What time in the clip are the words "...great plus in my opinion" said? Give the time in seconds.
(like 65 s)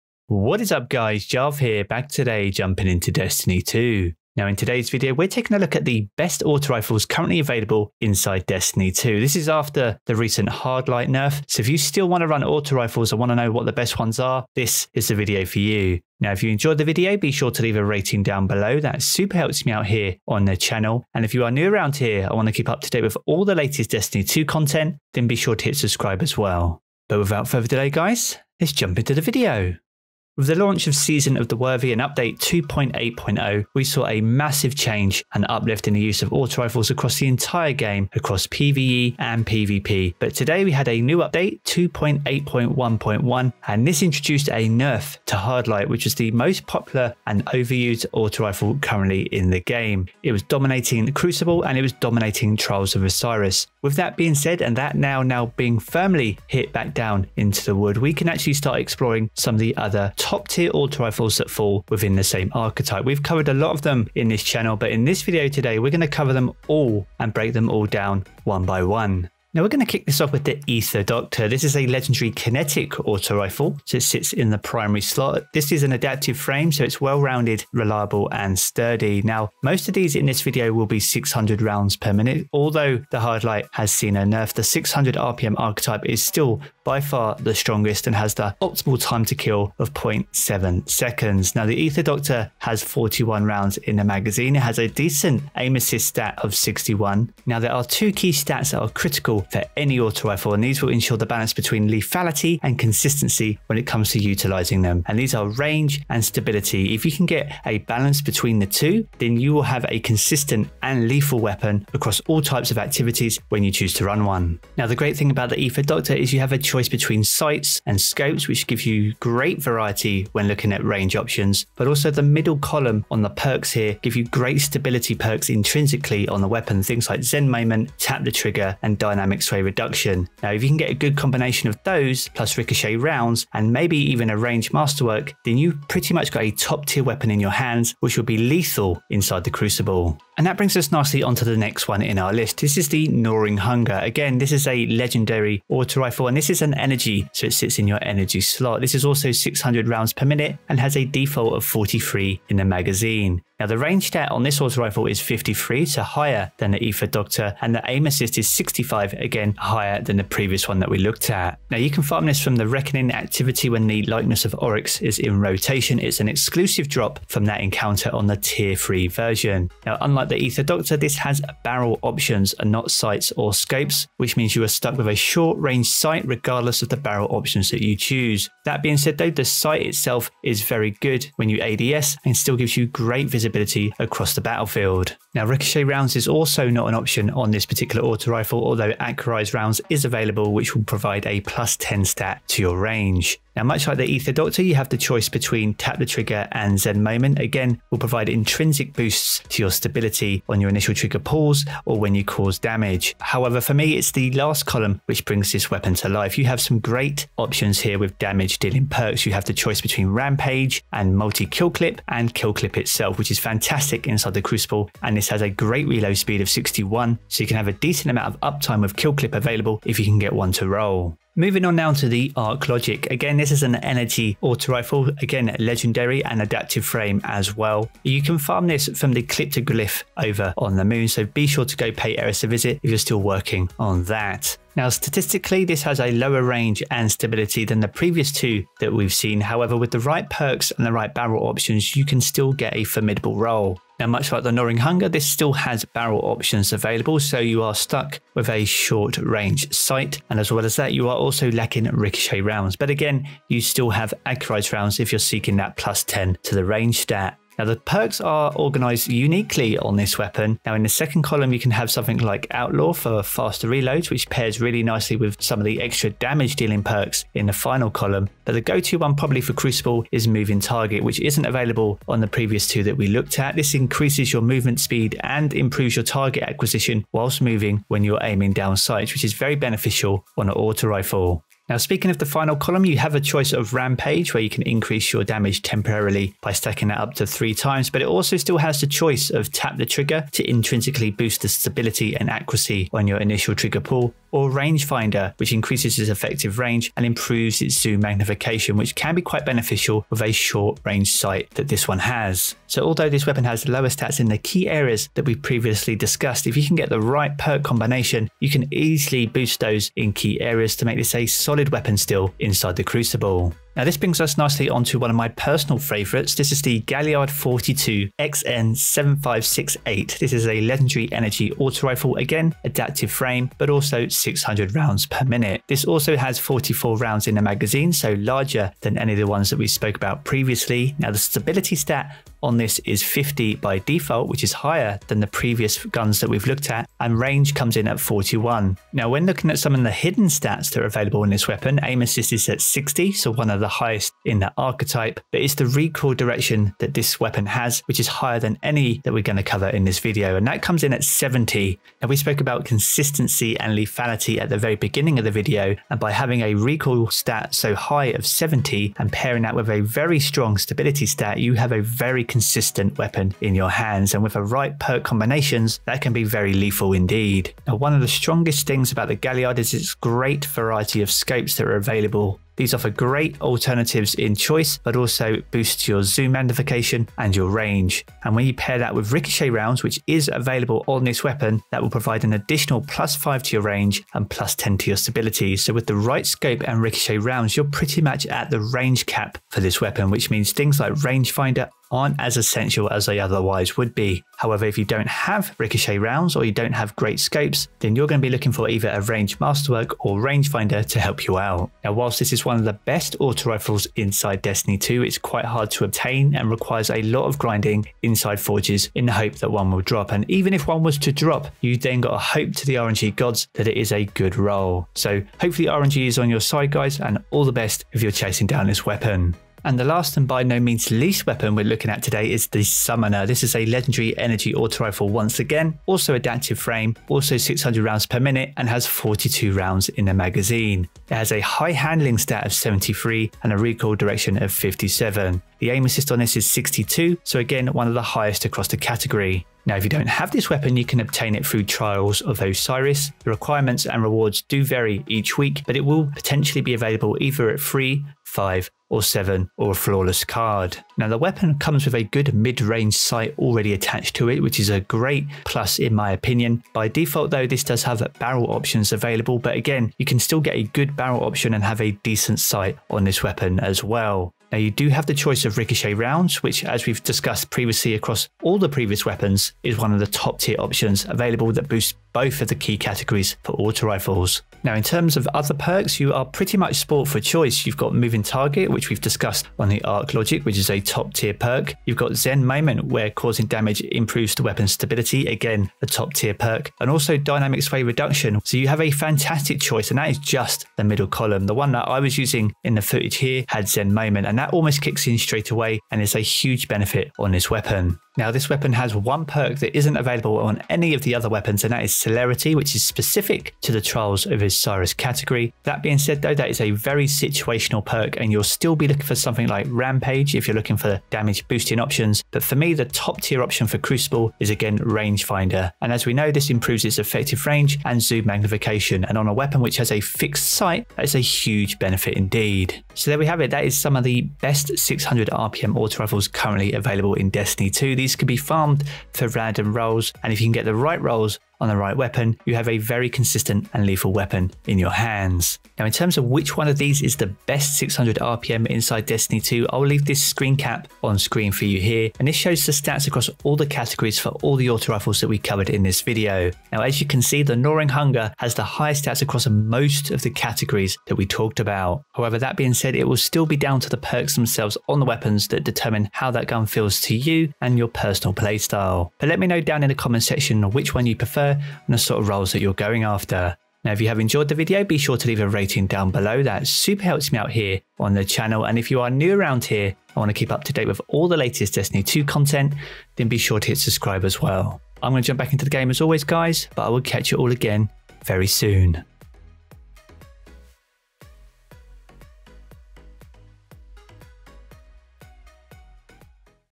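454 s.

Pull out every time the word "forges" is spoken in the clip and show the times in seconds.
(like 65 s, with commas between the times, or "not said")
408 s.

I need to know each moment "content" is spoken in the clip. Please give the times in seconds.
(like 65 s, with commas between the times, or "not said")
24 s, 572 s.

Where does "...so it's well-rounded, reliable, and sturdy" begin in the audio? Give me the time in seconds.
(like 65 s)
76 s.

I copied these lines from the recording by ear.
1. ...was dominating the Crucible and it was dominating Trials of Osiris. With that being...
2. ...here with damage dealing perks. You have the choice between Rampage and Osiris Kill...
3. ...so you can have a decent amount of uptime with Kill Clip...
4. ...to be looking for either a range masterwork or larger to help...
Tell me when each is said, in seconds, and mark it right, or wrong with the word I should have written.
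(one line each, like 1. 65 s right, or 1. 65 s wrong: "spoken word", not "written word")
1. 50 s right
2. 207 s wrong: "Multi", not "Osiris"
3. 217 s right
4. 398 s wrong: "rangefinder", not "larger".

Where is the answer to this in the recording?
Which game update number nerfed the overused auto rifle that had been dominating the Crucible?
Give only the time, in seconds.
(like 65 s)
41 s.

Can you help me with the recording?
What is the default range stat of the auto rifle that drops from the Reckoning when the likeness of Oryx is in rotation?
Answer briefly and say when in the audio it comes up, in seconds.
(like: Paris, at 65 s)
53, at 155 s.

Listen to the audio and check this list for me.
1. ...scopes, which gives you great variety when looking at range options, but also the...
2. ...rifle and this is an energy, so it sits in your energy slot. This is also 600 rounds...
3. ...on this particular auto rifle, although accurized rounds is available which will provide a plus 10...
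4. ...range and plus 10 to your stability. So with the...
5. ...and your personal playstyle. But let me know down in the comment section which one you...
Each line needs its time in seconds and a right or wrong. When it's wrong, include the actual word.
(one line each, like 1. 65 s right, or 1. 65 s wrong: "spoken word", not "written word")
1. 117 s right
2. 145 s right
3. 187 s right
4. 383 s right
5. 557 s right.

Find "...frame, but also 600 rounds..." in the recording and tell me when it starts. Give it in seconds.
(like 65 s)
323 s.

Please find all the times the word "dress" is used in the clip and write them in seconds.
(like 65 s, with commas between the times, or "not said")
not said.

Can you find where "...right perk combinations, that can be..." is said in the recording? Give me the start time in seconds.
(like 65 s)
364 s.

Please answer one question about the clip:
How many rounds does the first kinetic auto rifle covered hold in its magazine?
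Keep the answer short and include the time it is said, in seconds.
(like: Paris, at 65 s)
41, at 92 s.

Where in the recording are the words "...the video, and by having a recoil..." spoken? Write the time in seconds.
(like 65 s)
355 s.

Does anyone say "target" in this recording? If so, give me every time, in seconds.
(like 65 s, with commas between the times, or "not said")
270 s, 276 s, 478 s.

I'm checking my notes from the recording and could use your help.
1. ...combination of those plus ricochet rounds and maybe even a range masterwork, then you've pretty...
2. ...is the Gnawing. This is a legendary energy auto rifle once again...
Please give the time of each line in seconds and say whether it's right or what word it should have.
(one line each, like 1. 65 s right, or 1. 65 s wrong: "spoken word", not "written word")
1. 131 s right
2. 422 s wrong: "Summoner", not "Gnawing".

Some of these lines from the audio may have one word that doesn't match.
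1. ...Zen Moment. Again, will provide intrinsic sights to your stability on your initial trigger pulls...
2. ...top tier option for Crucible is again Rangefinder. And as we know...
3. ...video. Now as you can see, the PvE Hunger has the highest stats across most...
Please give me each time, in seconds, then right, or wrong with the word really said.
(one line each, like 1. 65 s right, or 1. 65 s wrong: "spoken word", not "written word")
1. 196 s wrong: "boosts", not "sights"
2. 512 s right
3. 546 s wrong: "Gnawing", not "PvE".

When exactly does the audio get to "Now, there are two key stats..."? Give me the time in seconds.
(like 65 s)
97 s.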